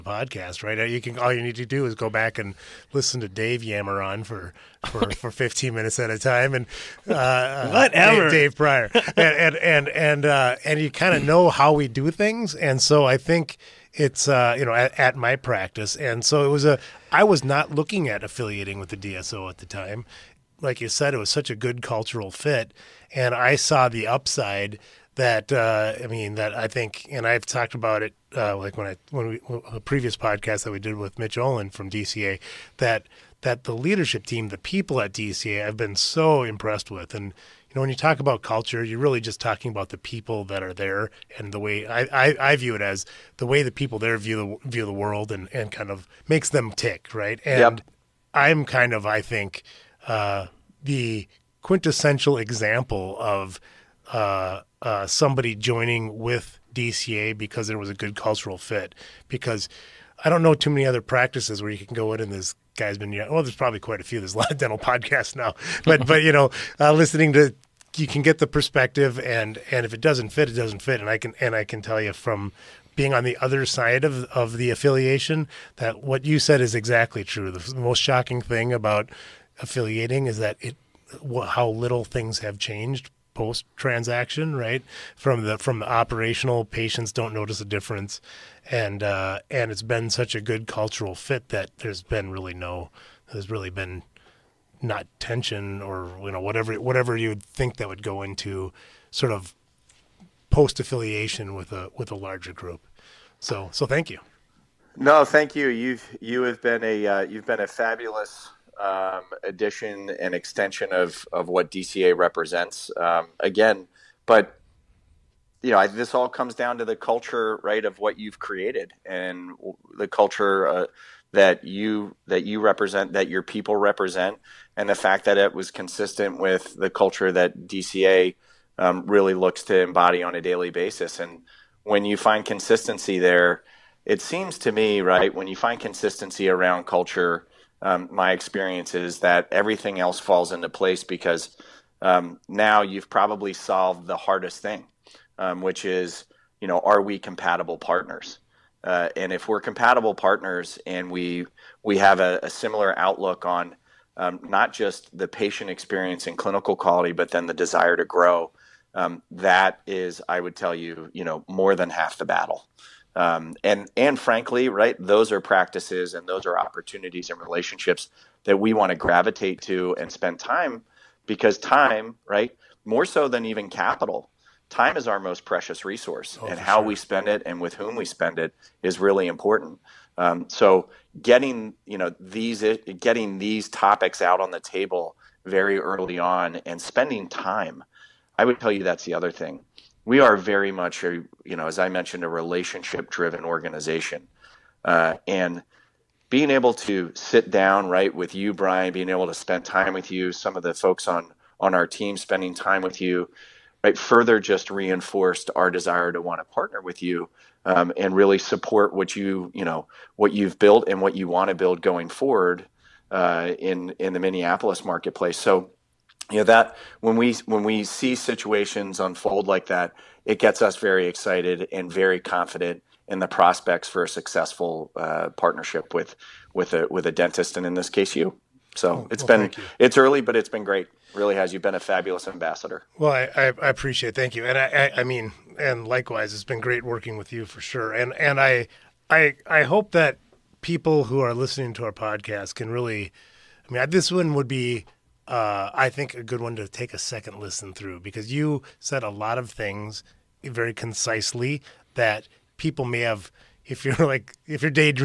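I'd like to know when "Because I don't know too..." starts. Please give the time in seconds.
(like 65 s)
59 s.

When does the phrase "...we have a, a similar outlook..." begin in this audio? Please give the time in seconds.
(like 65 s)
151 s.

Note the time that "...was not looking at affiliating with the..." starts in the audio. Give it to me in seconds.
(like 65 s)
17 s.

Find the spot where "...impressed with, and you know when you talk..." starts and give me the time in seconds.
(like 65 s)
36 s.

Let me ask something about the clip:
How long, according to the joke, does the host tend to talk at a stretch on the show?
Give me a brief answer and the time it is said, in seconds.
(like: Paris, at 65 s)
15 minutes, at 5 s.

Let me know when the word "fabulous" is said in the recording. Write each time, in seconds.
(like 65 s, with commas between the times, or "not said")
107 s, 231 s.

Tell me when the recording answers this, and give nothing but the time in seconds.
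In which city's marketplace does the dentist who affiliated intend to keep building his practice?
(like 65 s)
214 s.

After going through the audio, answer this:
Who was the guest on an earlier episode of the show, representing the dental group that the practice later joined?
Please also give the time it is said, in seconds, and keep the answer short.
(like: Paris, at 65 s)
Mitch Olin, at 31 s.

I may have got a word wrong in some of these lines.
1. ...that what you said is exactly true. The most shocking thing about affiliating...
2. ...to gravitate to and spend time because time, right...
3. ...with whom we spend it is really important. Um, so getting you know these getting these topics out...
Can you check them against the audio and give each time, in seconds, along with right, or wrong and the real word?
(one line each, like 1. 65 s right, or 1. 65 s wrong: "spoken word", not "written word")
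1. 75 s right
2. 168 s right
3. 177 s right.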